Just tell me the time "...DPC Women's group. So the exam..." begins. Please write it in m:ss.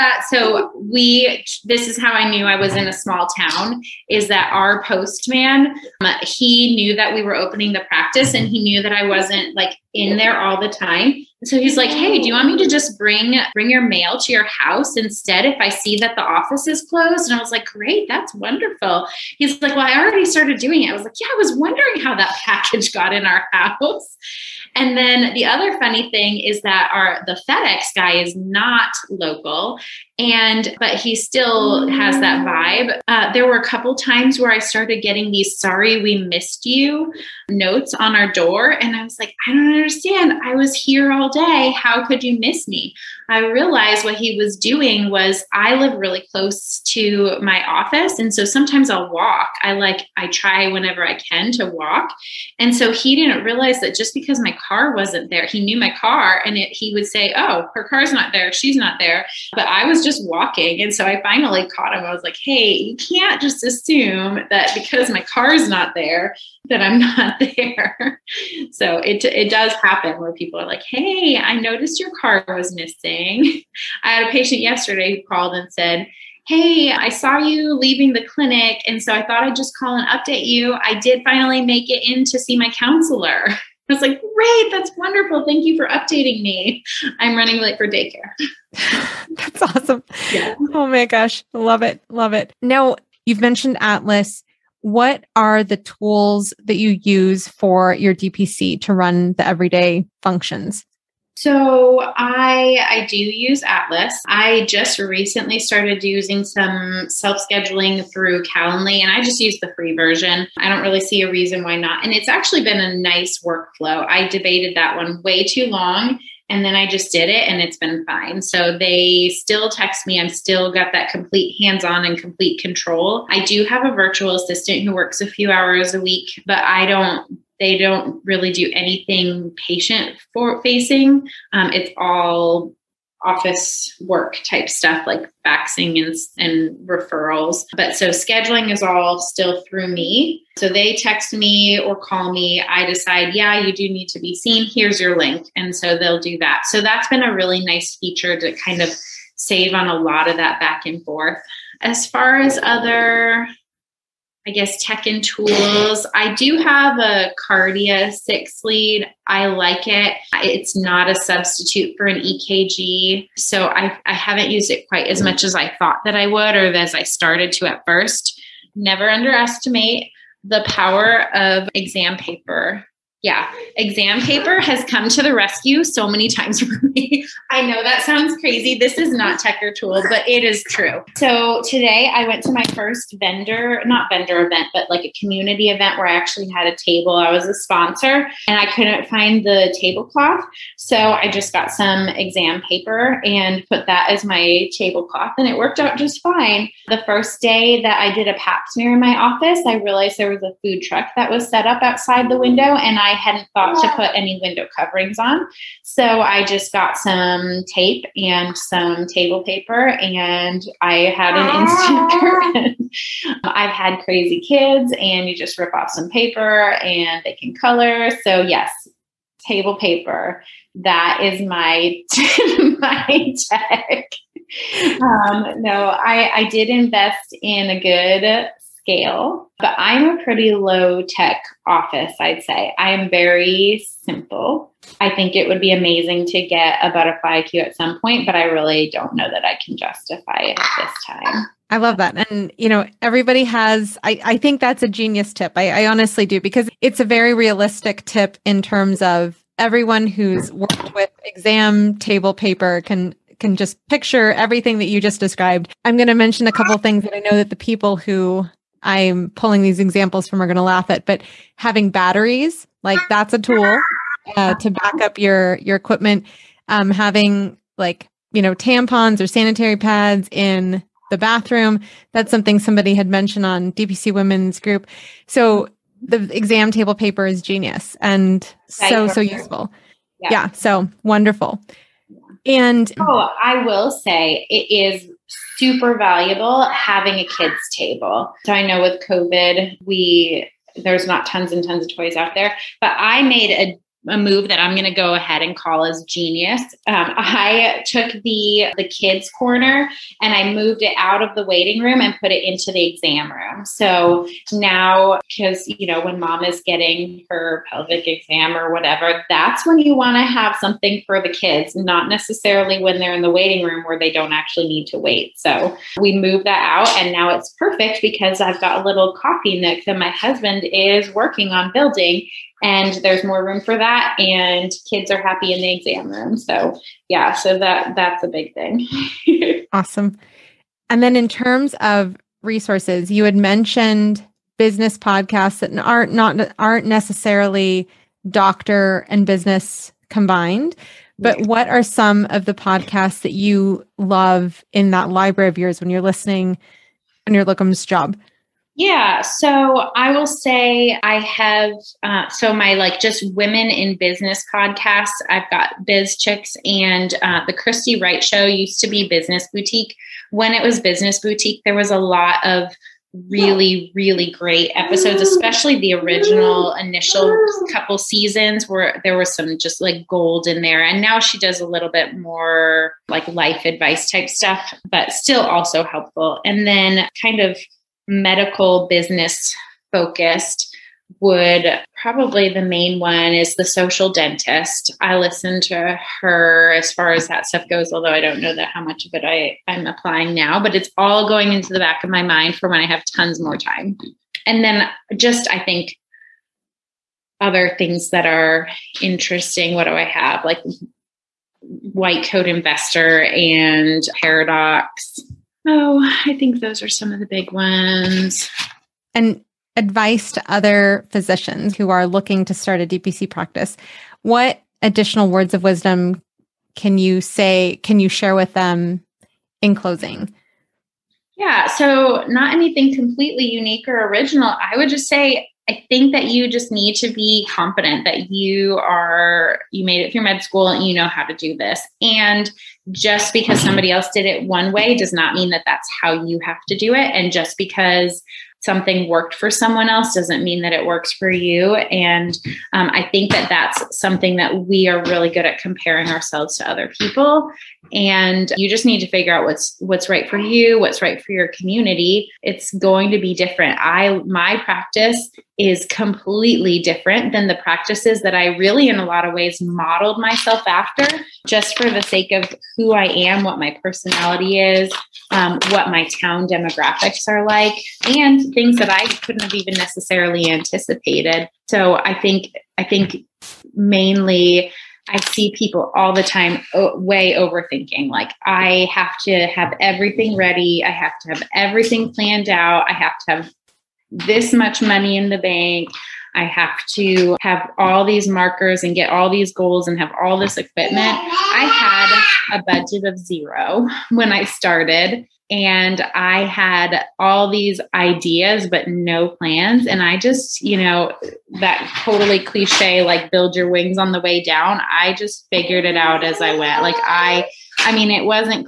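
4:33.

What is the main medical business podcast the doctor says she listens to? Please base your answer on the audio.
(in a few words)
The Social Dentist.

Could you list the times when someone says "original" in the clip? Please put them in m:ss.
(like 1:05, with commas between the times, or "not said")
6:05, 7:04.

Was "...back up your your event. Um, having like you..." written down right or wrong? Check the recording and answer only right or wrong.
wrong.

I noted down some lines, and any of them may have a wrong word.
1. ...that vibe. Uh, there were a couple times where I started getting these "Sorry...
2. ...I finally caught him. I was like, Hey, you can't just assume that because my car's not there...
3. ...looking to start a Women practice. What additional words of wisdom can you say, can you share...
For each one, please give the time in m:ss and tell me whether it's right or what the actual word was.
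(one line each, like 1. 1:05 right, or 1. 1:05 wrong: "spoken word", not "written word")
1. 0:32 right
2. 1:01 right
3. 6:52 wrong: "DPC", not "Women".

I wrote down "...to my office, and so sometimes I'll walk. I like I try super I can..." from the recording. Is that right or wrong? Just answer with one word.
wrong.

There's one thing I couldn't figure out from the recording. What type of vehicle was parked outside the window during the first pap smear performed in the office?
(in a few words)
food truck.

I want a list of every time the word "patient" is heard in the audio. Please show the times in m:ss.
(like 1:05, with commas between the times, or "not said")
1:14, 2:09.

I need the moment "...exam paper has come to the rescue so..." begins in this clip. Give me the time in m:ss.
2:53.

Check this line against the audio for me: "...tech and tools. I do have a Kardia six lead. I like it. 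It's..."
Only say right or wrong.
right.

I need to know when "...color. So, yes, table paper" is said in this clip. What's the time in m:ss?
3:37.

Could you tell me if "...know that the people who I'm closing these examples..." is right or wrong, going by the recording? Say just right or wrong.
wrong.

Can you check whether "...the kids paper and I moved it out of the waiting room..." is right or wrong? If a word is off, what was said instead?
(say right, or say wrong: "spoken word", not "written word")
wrong: "corner", not "paper".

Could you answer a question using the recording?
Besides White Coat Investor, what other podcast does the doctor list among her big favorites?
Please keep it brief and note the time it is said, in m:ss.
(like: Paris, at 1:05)
Paradocs, at 6:44.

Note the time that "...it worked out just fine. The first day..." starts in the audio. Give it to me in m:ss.
3:15.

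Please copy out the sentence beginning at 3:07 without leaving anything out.
I was a sponsor and I couldn't find the tablecloth.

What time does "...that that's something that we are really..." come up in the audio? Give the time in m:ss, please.
7:23.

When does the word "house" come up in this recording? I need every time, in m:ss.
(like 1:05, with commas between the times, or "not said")
0:14, 0:23.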